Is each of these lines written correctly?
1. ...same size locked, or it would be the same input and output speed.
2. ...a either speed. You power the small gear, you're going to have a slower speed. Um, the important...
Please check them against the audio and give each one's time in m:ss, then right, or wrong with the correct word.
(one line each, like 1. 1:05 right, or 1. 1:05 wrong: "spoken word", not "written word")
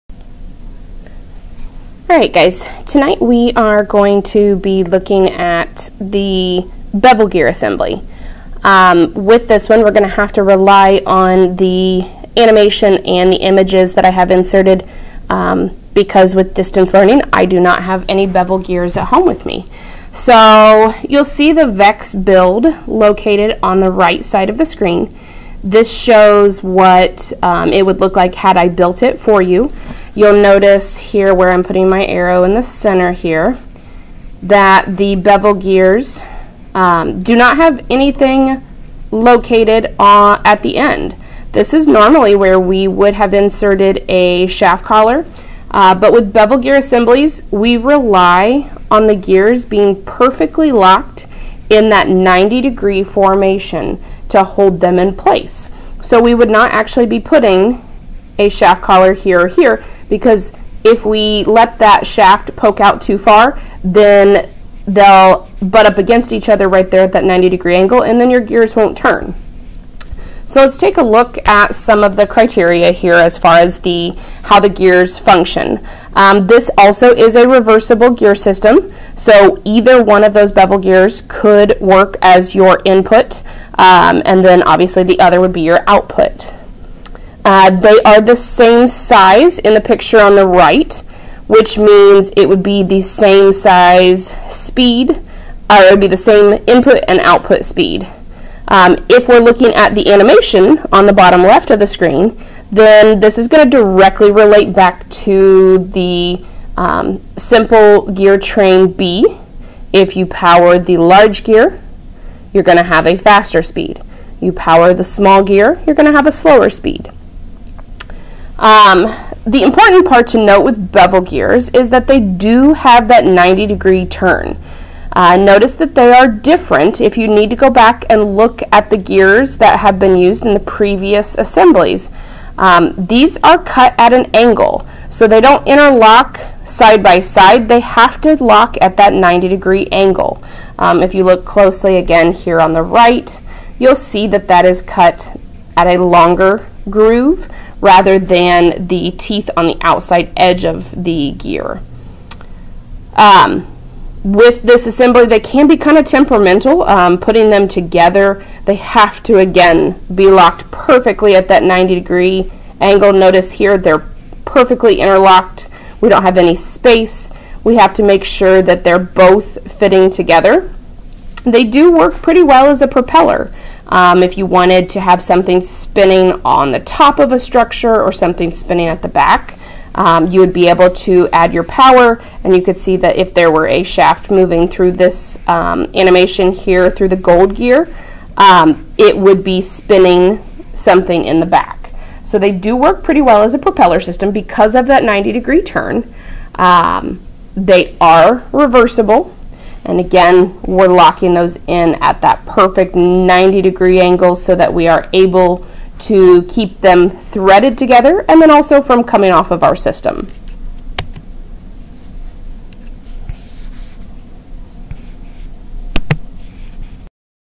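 1. 1:33 wrong: "speed", not "locked"
2. 1:53 wrong: "faster", not "either".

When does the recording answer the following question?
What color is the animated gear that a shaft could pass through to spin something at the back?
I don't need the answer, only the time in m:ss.
3:07.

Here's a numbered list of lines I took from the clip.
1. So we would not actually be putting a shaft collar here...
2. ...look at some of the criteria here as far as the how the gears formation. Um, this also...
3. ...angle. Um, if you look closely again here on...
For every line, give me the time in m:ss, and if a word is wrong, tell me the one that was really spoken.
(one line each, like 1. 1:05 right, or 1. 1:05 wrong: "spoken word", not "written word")
1. 0:56 right
2. 1:11 wrong: "function", not "formation"
3. 2:19 right.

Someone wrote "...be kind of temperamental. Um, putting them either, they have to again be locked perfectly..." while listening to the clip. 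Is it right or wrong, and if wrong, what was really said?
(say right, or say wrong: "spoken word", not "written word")
wrong: "together", not "either".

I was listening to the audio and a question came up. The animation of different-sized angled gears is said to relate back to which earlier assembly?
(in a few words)
Simple gear train B.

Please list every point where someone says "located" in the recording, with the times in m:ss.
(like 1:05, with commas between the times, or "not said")
0:22, 0:39.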